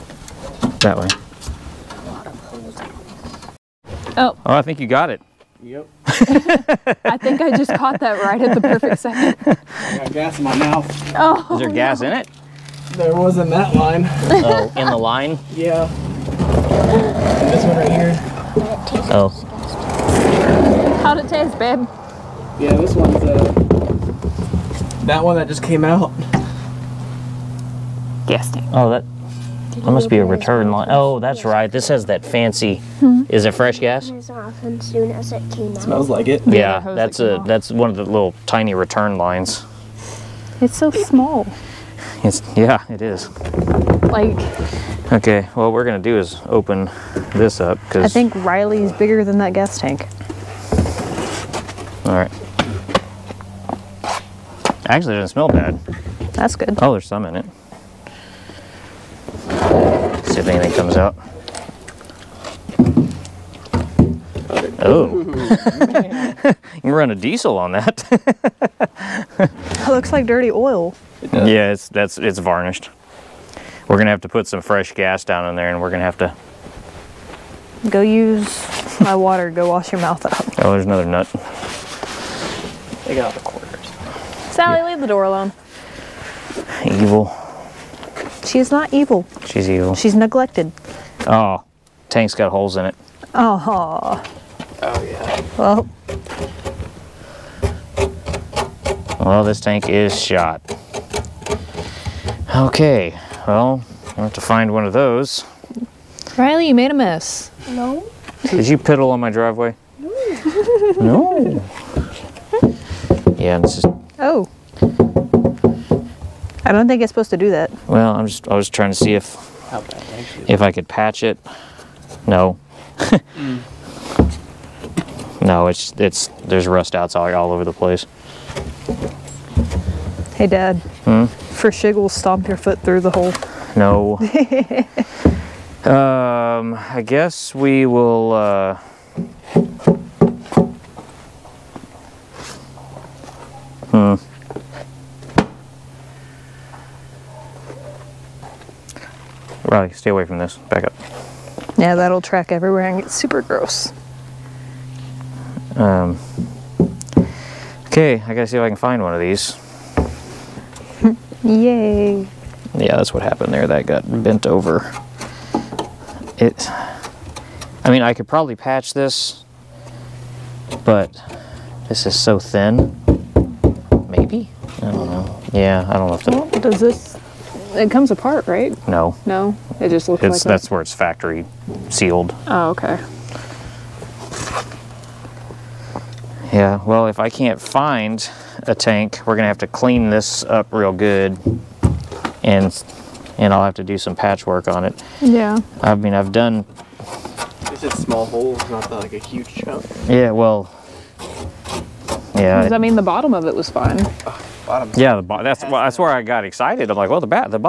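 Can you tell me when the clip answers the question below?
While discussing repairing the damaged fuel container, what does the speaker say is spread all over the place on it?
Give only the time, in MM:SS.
02:06.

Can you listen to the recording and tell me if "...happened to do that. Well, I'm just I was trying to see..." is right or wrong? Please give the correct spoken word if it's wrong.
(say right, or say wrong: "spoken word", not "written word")
wrong: "supposed", not "happened".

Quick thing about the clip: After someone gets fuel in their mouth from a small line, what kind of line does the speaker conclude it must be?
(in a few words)
return line.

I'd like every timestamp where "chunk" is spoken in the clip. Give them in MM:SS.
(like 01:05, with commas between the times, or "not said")
03:19.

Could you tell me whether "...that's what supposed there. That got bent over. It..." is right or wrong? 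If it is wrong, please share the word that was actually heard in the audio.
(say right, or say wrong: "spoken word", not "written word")
wrong: "happened", not "supposed".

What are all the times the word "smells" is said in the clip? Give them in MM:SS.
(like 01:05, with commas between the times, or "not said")
00:35, 00:55.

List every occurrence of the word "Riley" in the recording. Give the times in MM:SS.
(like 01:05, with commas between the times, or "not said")
00:48, 01:46, 02:29.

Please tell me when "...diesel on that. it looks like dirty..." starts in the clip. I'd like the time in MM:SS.
01:07.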